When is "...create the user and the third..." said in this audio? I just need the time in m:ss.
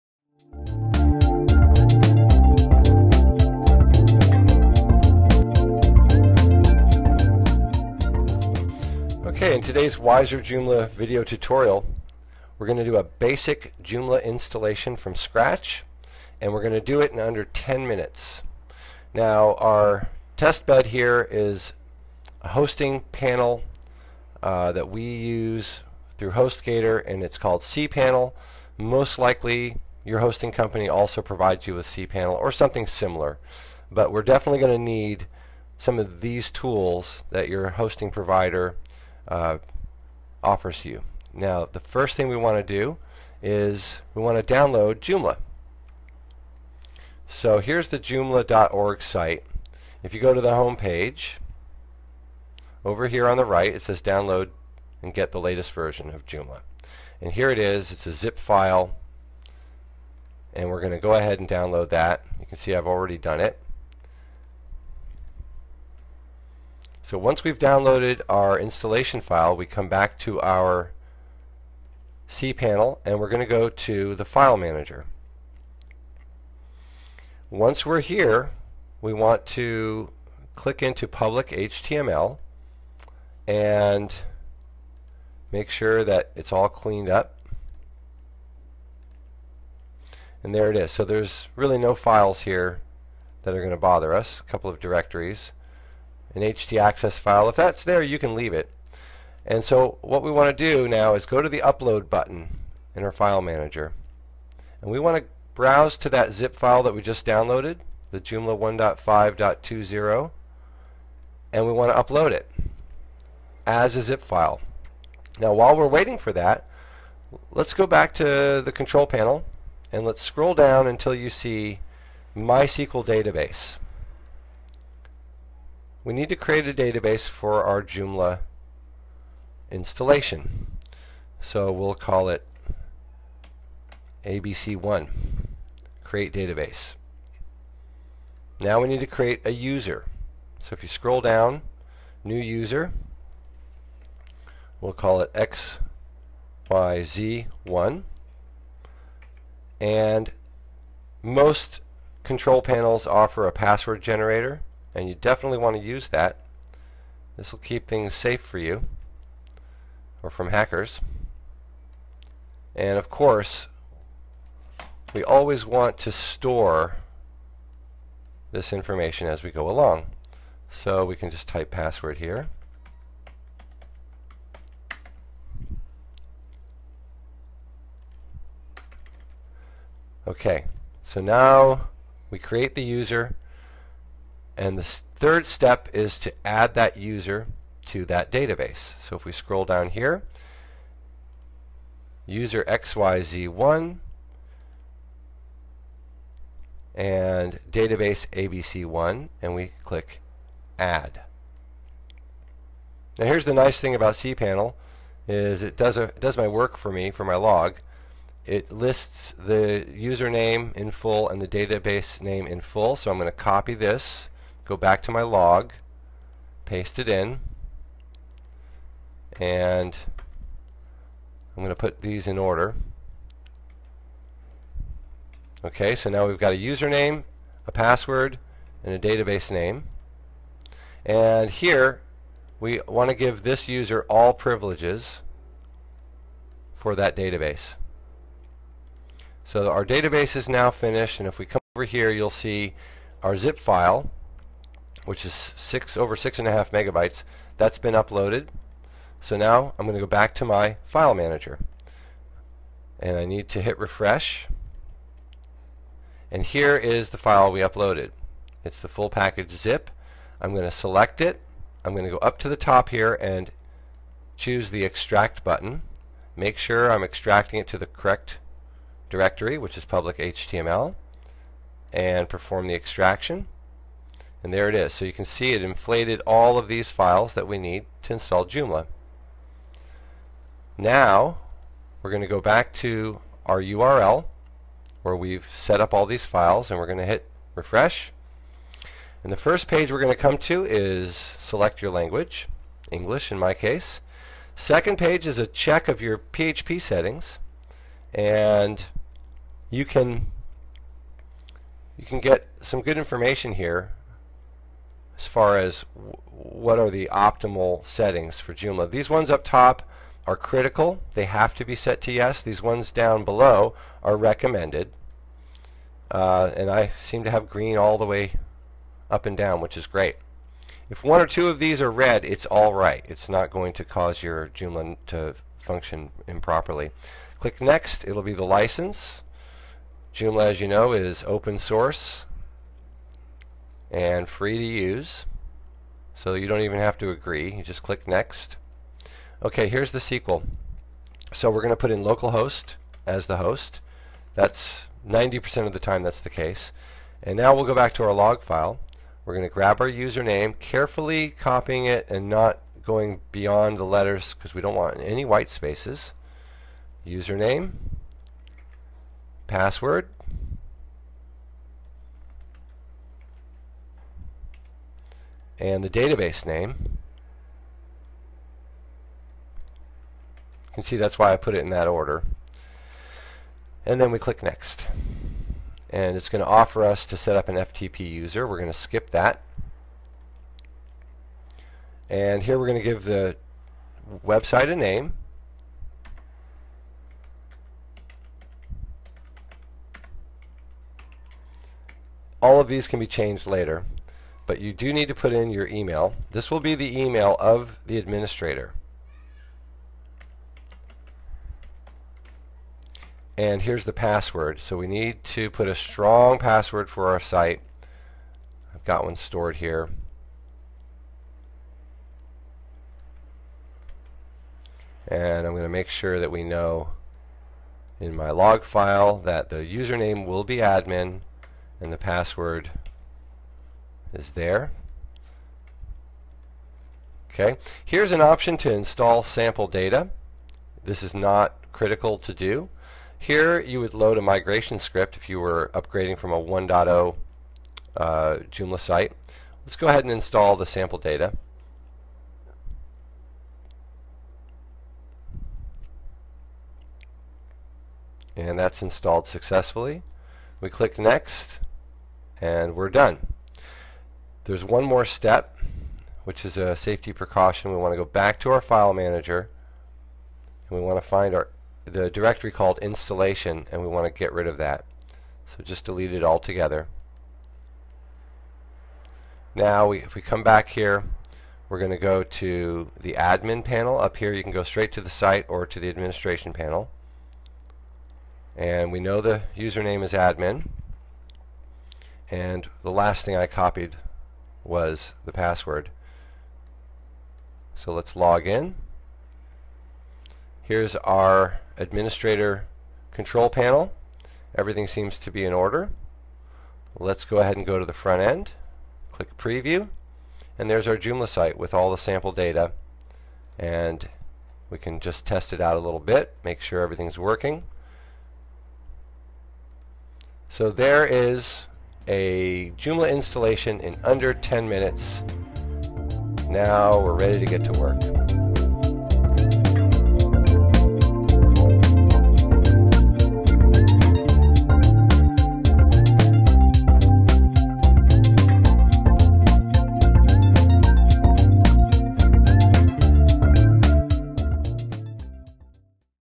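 3:02.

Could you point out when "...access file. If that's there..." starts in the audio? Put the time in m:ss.
1:36.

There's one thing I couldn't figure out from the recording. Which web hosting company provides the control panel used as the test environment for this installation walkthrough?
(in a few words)
HostGator.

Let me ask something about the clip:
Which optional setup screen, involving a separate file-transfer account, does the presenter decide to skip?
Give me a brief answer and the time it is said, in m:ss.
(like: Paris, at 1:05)
FTP user, at 6:17.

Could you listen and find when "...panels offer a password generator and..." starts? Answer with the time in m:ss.
2:32.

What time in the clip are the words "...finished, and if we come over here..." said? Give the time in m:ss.
4:00.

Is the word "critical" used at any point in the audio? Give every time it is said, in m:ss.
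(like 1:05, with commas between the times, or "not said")
5:10, 7:11.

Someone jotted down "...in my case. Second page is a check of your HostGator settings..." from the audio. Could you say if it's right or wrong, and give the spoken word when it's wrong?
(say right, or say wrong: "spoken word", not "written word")
wrong: "PHP", not "HostGator".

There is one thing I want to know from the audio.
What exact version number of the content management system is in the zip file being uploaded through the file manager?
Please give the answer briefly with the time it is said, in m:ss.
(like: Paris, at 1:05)
1.5.20, at 1:48.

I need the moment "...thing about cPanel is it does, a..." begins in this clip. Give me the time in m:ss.
3:23.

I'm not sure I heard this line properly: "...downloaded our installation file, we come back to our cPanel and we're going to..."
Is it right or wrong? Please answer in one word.
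right.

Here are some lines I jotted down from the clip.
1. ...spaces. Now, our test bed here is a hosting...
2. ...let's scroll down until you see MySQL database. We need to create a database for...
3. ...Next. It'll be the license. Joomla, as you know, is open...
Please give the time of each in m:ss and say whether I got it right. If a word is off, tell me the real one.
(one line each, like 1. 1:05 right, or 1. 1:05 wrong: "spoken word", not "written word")
1. 0:17 wrong: "minutes", not "spaces"
2. 2:00 right
3. 5:27 right.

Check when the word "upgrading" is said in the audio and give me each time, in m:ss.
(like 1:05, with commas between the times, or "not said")
7:15.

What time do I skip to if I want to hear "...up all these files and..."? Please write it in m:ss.
4:45.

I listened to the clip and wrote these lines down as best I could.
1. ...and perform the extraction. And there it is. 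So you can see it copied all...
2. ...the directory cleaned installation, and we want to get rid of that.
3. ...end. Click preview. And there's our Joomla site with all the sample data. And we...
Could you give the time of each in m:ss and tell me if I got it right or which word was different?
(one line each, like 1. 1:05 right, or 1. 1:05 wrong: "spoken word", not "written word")
1. 4:31 wrong: "inflated", not "copied"
2. 7:41 wrong: "called", not "cleaned"
3. 8:18 right.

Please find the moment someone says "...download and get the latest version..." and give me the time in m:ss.
0:54.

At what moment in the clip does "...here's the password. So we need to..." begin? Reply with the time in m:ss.
6:43.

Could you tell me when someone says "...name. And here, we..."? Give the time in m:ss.
3:49.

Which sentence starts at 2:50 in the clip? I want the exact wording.
So we can just type password here.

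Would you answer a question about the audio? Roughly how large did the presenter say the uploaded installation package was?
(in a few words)
6.5 megabytes.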